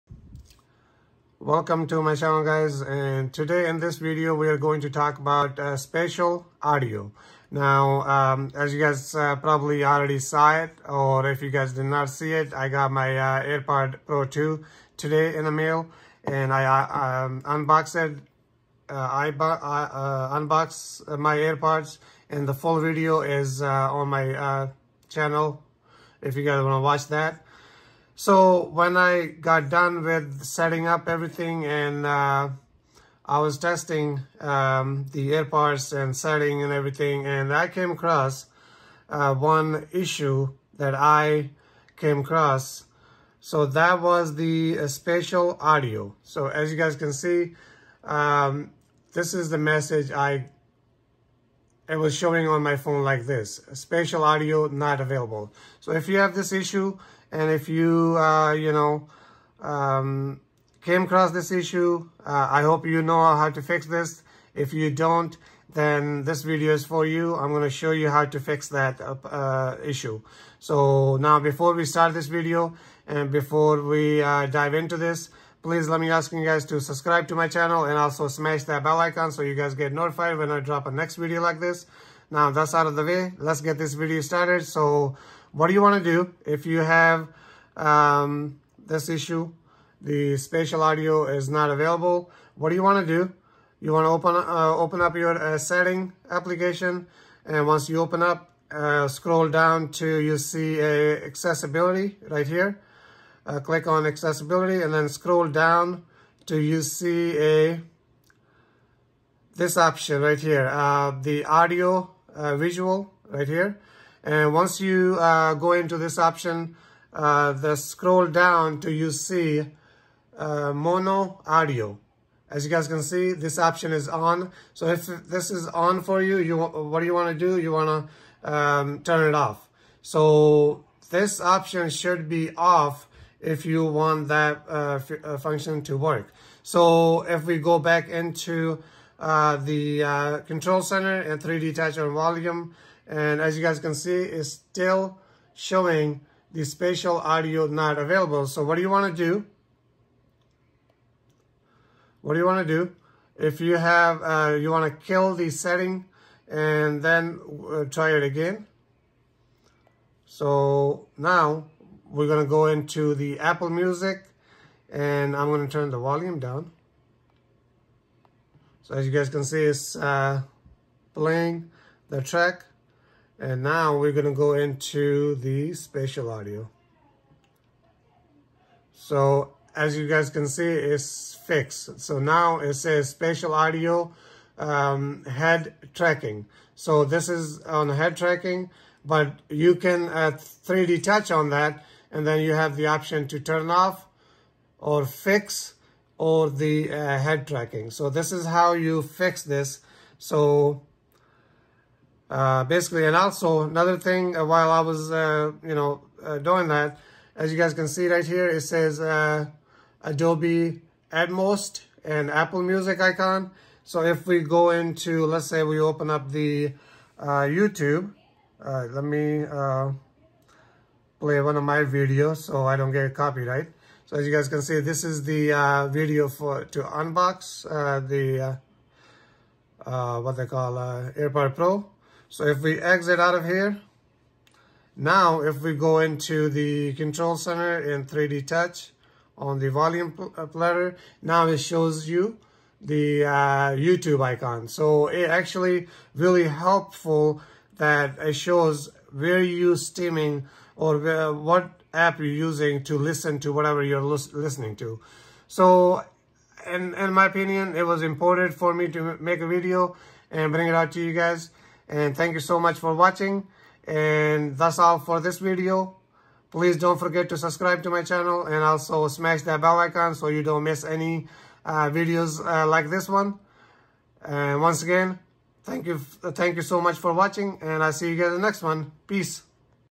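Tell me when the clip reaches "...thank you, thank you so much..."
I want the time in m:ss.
4:35.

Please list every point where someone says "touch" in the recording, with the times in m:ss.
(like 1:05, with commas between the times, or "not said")
2:21, 3:11, 3:58.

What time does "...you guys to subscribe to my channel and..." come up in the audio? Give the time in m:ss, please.
1:16.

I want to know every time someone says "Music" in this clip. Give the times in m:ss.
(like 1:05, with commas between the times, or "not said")
2:43, 3:32.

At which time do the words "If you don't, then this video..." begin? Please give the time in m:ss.
1:04.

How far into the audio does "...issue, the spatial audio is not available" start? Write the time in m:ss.
1:29.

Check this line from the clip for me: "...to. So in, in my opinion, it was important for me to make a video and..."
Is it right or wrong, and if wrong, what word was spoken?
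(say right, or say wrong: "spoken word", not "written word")
right.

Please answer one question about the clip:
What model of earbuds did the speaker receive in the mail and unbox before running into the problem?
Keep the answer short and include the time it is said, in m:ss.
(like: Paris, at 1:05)
AirPod Pro 2, at 0:13.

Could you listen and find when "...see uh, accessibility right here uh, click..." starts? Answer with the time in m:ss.
1:40.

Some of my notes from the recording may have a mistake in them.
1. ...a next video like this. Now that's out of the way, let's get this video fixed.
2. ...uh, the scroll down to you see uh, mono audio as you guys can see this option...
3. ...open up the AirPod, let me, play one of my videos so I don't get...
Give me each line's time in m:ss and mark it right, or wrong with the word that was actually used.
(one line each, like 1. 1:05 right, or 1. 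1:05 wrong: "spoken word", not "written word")
1. 1:20 wrong: "started", not "fixed"
2. 1:57 right
3. 3:35 wrong: "YouTube", not "AirPod".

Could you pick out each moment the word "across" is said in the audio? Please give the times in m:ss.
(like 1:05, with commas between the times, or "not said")
0:37, 0:42, 1:01.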